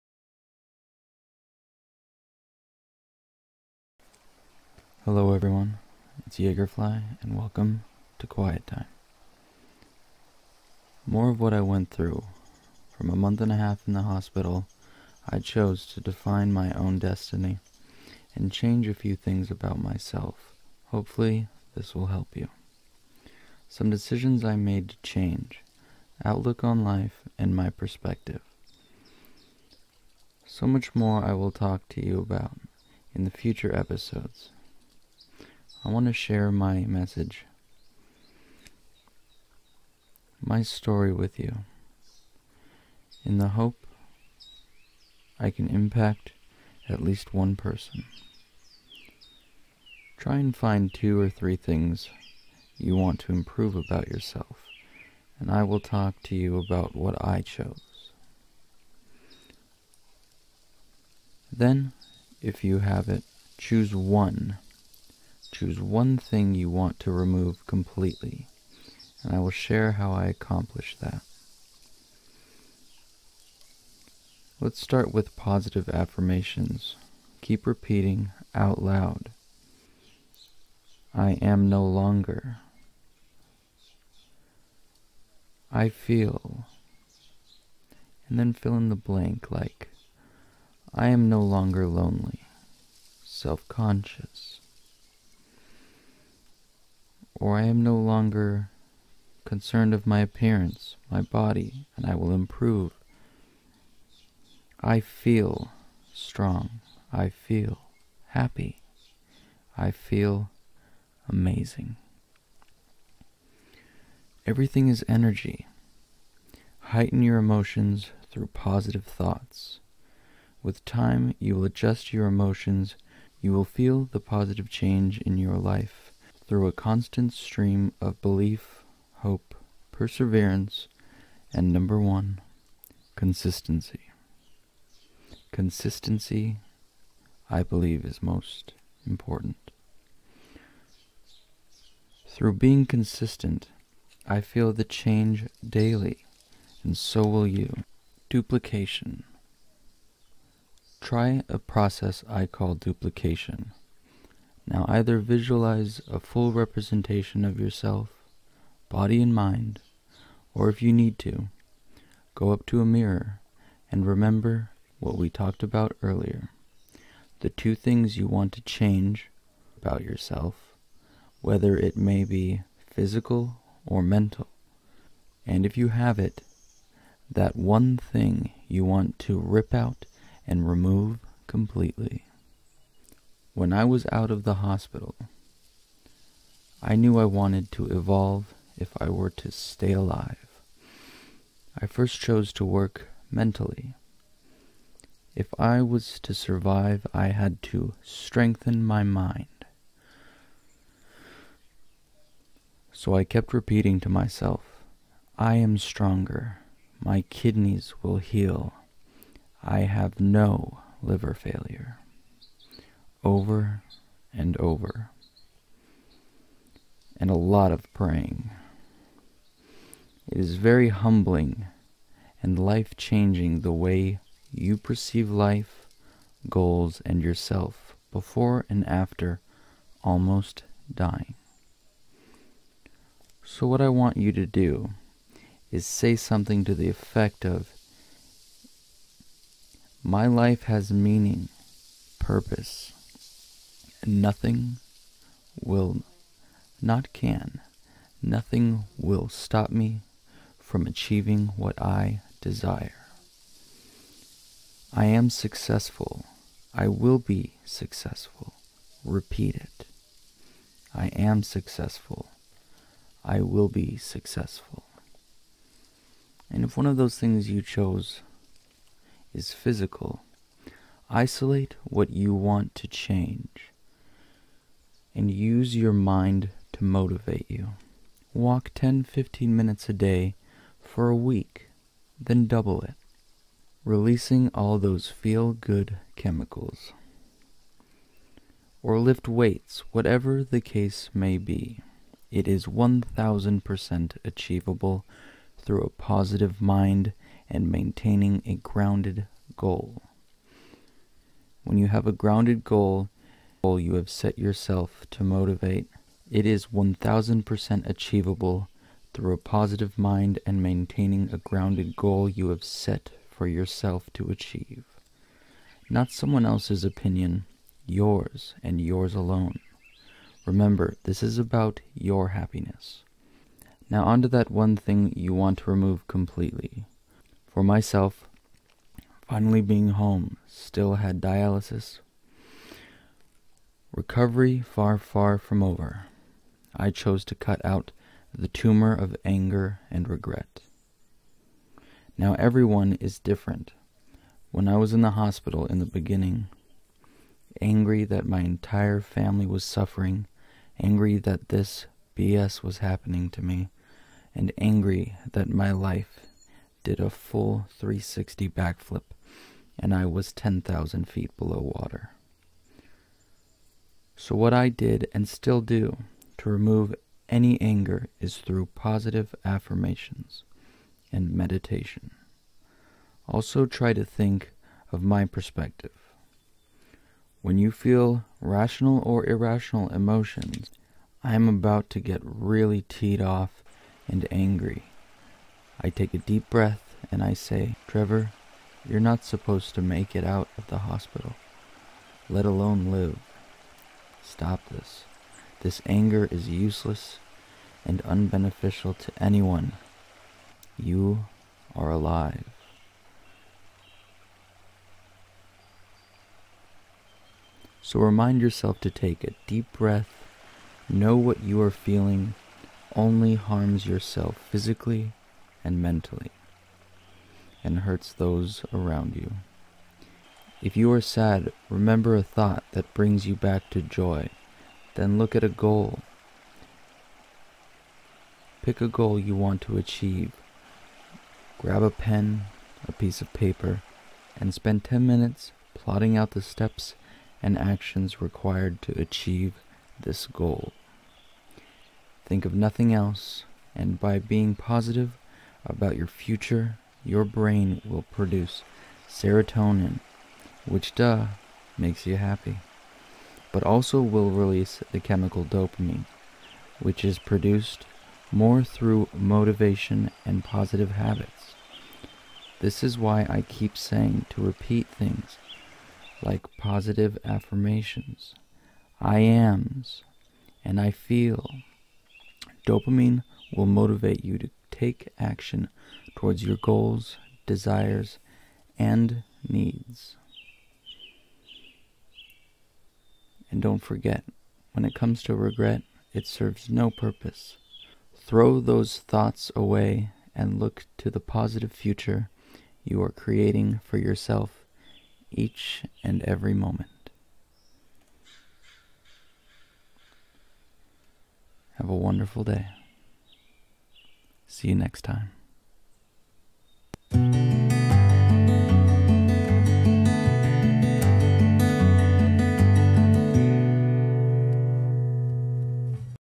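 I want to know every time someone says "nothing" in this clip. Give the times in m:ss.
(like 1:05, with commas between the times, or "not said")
4:04, 4:08, 7:22.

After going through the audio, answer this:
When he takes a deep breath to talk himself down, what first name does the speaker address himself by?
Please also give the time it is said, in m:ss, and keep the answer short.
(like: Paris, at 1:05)
Trevor, at 6:27.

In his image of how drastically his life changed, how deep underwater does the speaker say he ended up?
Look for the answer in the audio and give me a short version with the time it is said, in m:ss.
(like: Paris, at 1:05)
10,000 feet, at 6:00.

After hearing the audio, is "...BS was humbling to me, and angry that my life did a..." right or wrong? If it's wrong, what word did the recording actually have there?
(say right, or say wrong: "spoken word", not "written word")
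wrong: "happening", not "humbling".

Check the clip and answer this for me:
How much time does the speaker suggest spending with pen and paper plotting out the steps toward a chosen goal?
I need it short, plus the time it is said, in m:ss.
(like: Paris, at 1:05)
10 minutes, at 7:14.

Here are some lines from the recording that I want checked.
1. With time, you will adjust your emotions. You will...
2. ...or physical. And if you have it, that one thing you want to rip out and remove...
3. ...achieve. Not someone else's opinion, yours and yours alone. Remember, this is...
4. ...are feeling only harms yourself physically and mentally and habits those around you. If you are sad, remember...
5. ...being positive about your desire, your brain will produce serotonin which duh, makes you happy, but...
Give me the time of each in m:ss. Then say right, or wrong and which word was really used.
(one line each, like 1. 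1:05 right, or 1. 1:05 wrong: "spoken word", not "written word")
1. 2:00 right
2. 2:53 wrong: "mental", not "physical"
3. 5:14 right
4. 6:51 wrong: "hurts", not "habits"
5. 7:24 wrong: "future", not "desire".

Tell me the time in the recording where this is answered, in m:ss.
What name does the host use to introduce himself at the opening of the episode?
0:06.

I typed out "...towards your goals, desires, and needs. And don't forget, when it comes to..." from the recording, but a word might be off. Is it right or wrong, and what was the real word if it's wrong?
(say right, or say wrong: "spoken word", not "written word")
right.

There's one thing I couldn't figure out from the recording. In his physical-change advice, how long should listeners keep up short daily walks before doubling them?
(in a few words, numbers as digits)
a week.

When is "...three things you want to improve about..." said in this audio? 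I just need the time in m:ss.
0:51.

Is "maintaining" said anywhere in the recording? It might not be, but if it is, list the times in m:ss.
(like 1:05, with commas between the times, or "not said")
4:57, 5:10.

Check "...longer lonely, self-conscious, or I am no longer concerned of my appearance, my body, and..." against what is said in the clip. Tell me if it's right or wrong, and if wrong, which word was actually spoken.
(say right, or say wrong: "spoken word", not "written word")
right.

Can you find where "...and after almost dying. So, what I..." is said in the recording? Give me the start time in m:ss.
3:48.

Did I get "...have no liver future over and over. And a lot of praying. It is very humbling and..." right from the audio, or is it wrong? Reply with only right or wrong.
wrong.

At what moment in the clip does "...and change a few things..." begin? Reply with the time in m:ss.
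0:18.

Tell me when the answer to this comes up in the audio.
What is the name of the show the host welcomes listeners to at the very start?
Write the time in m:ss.
0:08.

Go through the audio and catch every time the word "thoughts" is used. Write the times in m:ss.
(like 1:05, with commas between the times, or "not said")
1:59, 7:02, 8:08.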